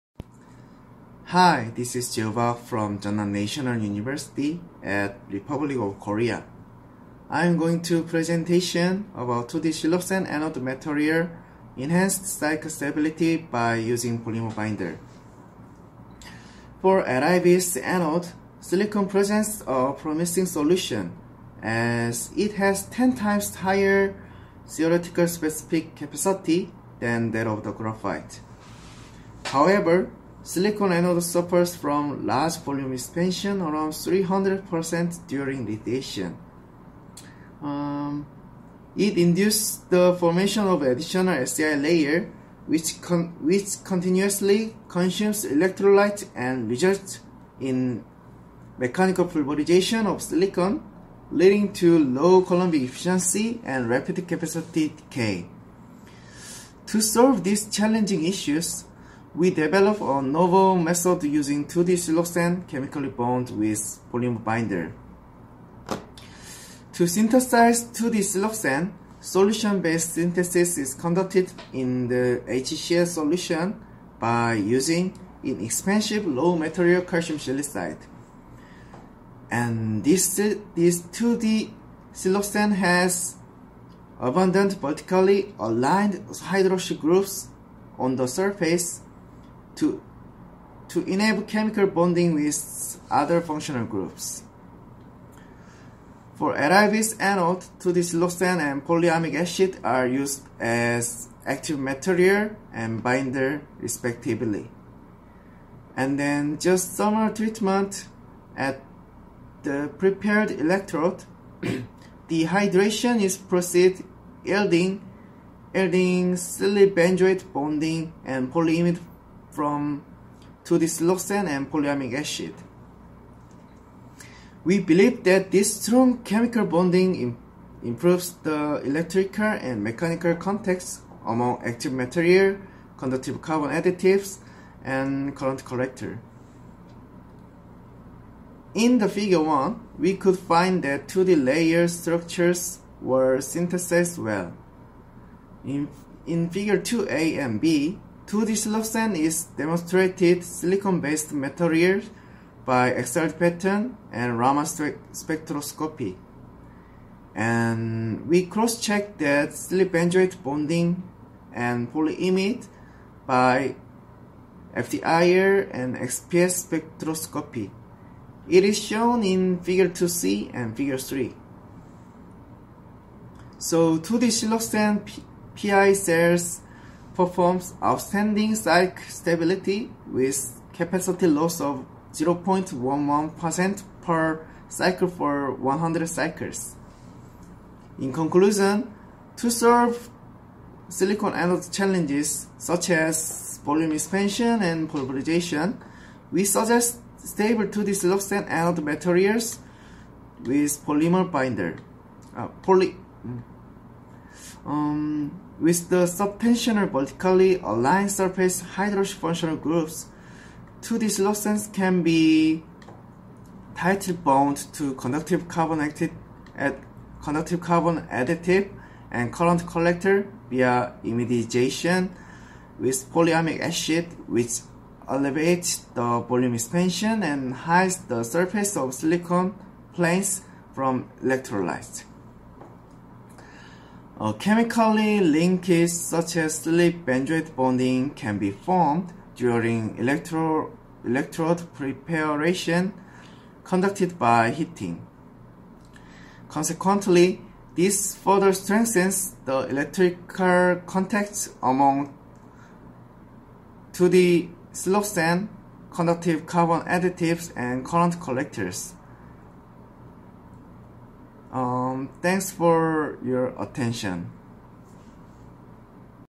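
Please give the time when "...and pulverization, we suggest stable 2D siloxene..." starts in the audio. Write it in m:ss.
3:14.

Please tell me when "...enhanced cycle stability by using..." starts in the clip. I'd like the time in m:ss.
0:11.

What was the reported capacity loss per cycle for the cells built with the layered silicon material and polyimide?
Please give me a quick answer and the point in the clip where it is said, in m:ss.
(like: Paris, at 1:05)
0.11%, at 3:02.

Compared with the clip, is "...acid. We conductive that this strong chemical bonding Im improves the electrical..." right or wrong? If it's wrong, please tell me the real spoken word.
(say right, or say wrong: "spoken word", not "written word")
wrong: "believe", not "conductive".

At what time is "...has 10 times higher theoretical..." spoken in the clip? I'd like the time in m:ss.
0:22.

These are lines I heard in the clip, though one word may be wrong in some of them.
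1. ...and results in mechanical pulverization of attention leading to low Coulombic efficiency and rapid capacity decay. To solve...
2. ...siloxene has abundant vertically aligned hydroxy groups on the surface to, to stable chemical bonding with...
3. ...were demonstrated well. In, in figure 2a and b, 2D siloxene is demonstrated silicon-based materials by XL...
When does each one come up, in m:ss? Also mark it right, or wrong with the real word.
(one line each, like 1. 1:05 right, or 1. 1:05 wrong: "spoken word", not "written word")
1. 0:46 wrong: "silicon", not "attention"
2. 1:22 wrong: "enable", not "stable"
3. 2:23 wrong: "synthesized", not "demonstrated".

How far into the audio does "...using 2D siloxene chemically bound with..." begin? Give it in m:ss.
1:01.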